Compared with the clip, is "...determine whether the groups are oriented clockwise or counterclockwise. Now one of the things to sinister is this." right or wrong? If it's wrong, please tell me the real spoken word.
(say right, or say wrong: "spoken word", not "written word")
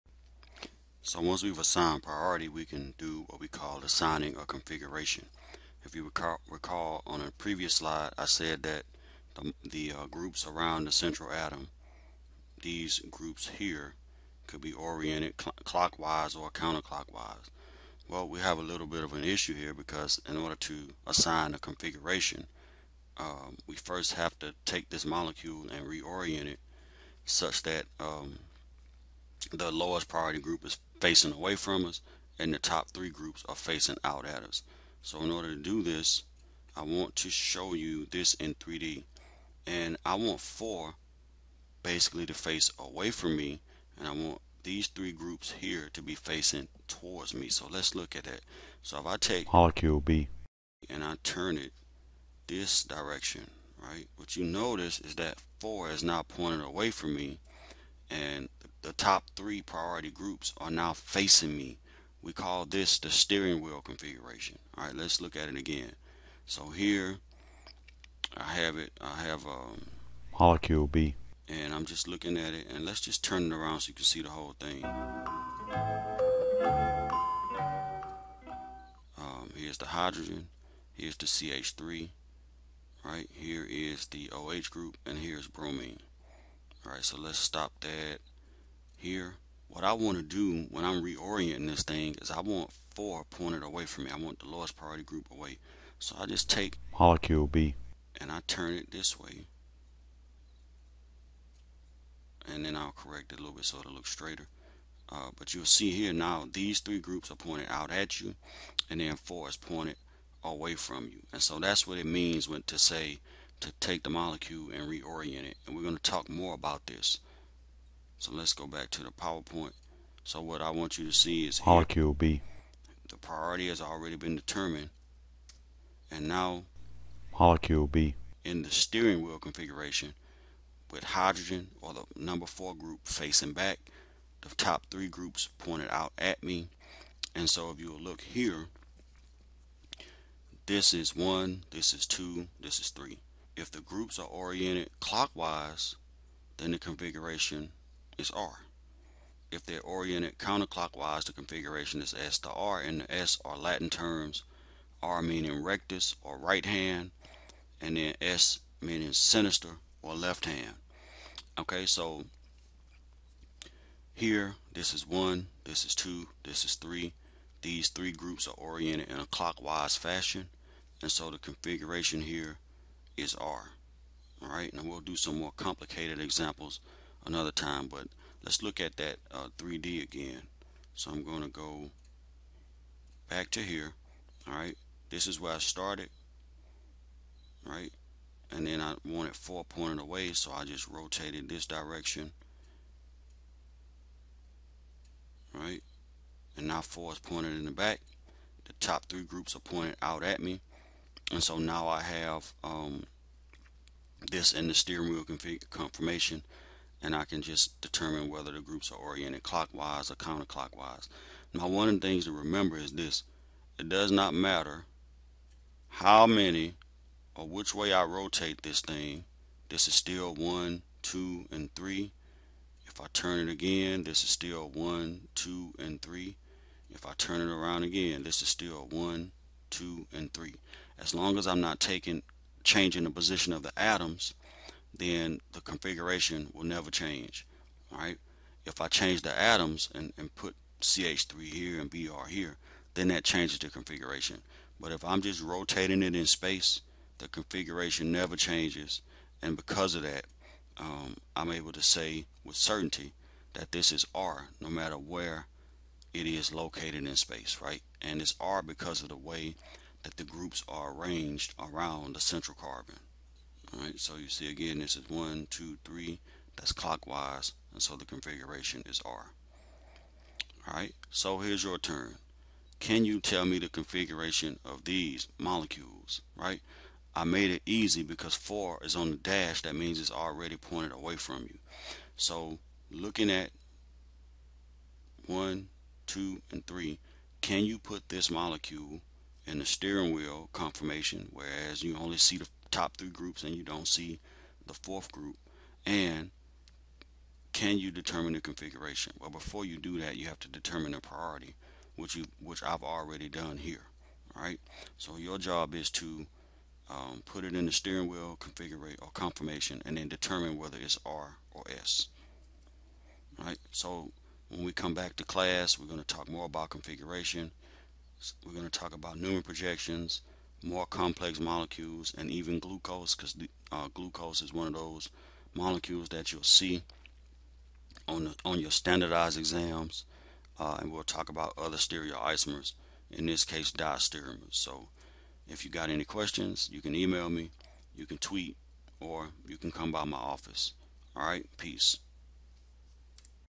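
wrong: "remember", not "sinister".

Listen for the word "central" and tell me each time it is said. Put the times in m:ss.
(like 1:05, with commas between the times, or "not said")
0:10, 4:22.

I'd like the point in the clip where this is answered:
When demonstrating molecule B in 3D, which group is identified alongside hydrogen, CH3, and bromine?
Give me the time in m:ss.
1:24.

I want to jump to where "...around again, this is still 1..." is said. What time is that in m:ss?
3:47.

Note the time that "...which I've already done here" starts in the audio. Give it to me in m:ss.
5:02.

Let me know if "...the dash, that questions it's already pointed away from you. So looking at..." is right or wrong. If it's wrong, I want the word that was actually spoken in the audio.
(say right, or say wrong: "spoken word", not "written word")
wrong: "means", not "questions".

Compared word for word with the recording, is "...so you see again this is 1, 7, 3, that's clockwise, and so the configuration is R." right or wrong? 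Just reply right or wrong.
wrong.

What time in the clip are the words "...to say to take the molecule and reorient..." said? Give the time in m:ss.
1:52.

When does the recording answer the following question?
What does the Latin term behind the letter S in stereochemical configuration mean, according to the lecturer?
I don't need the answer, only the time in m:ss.
2:40.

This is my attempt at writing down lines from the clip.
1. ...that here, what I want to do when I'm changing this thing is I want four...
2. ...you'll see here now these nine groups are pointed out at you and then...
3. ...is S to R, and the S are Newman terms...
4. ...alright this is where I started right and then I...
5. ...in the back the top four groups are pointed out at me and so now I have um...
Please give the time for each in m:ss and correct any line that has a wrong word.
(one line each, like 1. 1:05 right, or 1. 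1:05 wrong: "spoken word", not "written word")
1. 1:27 wrong: "reorienting", not "changing"
2. 1:45 wrong: "three", not "nine"
3. 2:32 wrong: "Latin", not "Newman"
4. 3:04 right
5. 3:17 wrong: "three", not "four".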